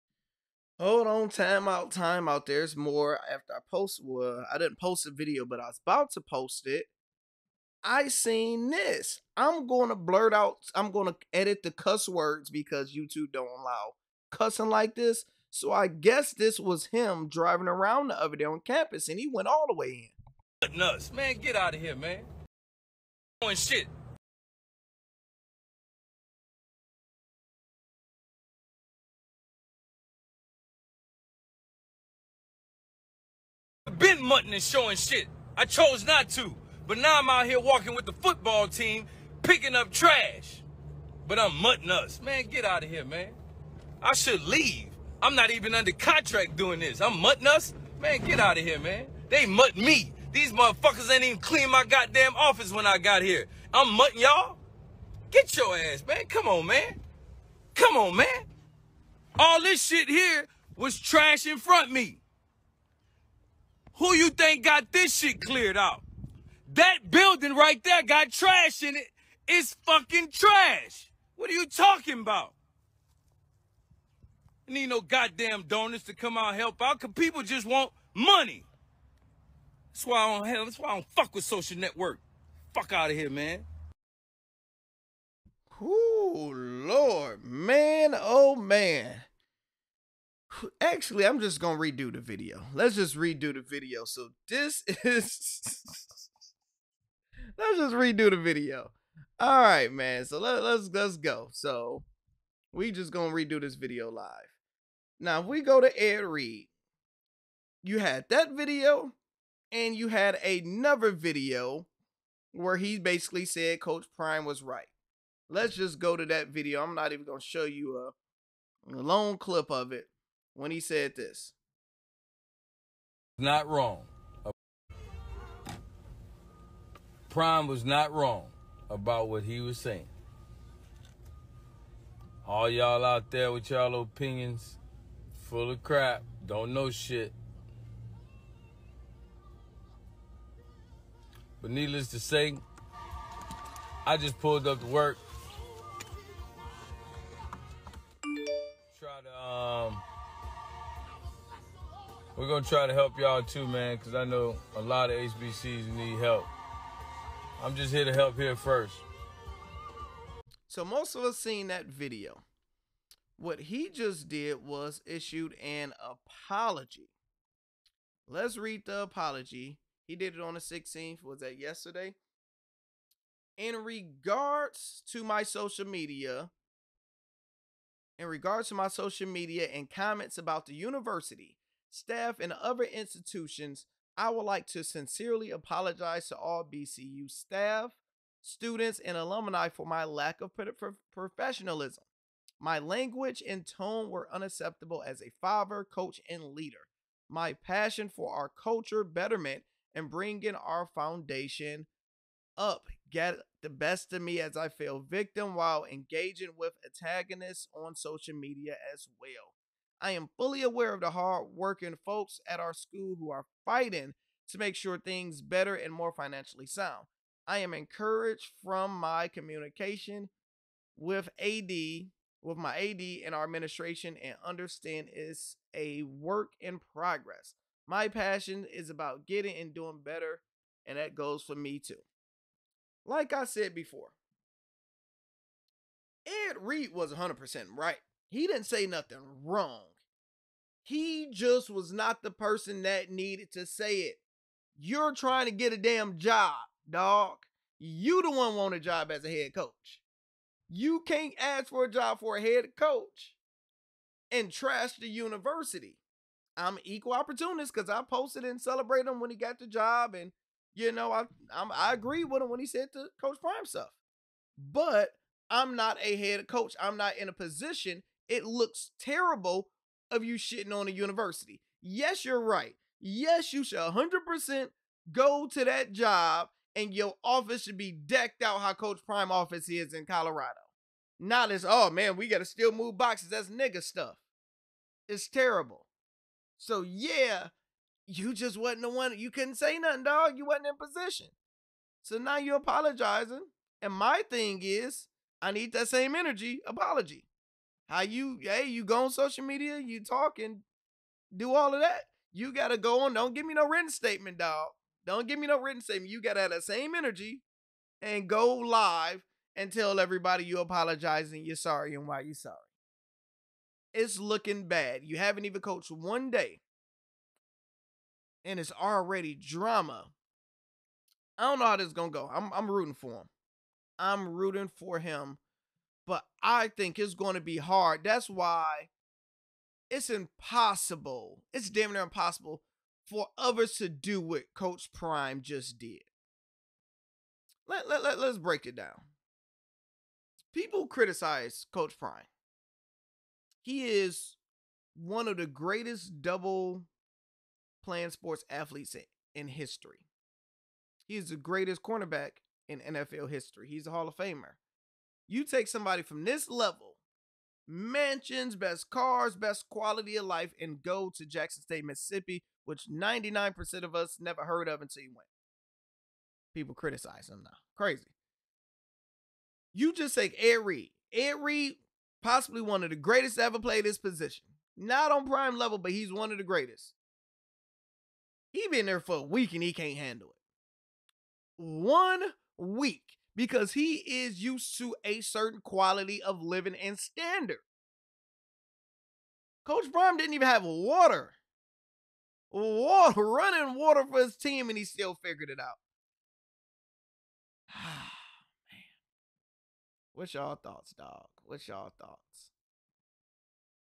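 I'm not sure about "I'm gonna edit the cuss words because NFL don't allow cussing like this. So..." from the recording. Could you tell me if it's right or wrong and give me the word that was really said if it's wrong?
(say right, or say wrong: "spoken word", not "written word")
wrong: "YouTube", not "NFL".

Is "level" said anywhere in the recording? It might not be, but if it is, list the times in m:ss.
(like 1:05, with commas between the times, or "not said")
5:56, 6:15.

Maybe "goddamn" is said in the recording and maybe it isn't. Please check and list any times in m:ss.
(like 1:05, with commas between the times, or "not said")
0:51, 1:15.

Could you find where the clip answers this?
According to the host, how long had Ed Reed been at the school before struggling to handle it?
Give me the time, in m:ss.
6:18.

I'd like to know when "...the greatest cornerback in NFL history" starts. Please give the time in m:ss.
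5:51.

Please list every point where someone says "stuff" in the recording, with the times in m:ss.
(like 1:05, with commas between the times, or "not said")
4:23, 4:43.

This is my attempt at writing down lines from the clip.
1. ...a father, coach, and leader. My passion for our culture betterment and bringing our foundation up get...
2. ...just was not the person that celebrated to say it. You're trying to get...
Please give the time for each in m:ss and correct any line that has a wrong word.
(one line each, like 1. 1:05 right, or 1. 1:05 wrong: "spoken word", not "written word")
1. 3:15 right
2. 4:01 wrong: "needed", not "celebrated".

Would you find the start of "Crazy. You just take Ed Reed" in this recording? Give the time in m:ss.
6:07.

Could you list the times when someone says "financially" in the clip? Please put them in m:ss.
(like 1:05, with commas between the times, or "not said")
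3:36.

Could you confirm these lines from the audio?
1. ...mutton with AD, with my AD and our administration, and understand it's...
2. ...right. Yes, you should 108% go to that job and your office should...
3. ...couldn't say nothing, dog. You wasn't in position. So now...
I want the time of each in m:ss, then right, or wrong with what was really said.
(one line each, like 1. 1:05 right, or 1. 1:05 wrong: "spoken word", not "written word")
1. 3:39 wrong: "communication", not "mutton"
2. 4:32 wrong: "100", not "108"
3. 4:49 right.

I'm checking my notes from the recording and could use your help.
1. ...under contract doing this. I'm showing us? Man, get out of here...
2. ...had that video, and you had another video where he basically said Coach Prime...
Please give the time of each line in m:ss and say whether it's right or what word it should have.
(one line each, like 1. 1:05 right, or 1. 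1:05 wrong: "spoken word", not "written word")
1. 0:45 wrong: "mutting", not "showing"
2. 1:47 right.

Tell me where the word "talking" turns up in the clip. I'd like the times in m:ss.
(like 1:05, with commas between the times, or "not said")
1:11, 5:00.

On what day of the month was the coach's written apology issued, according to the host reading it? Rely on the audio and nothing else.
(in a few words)
16th.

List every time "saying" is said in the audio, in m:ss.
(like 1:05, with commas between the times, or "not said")
2:09.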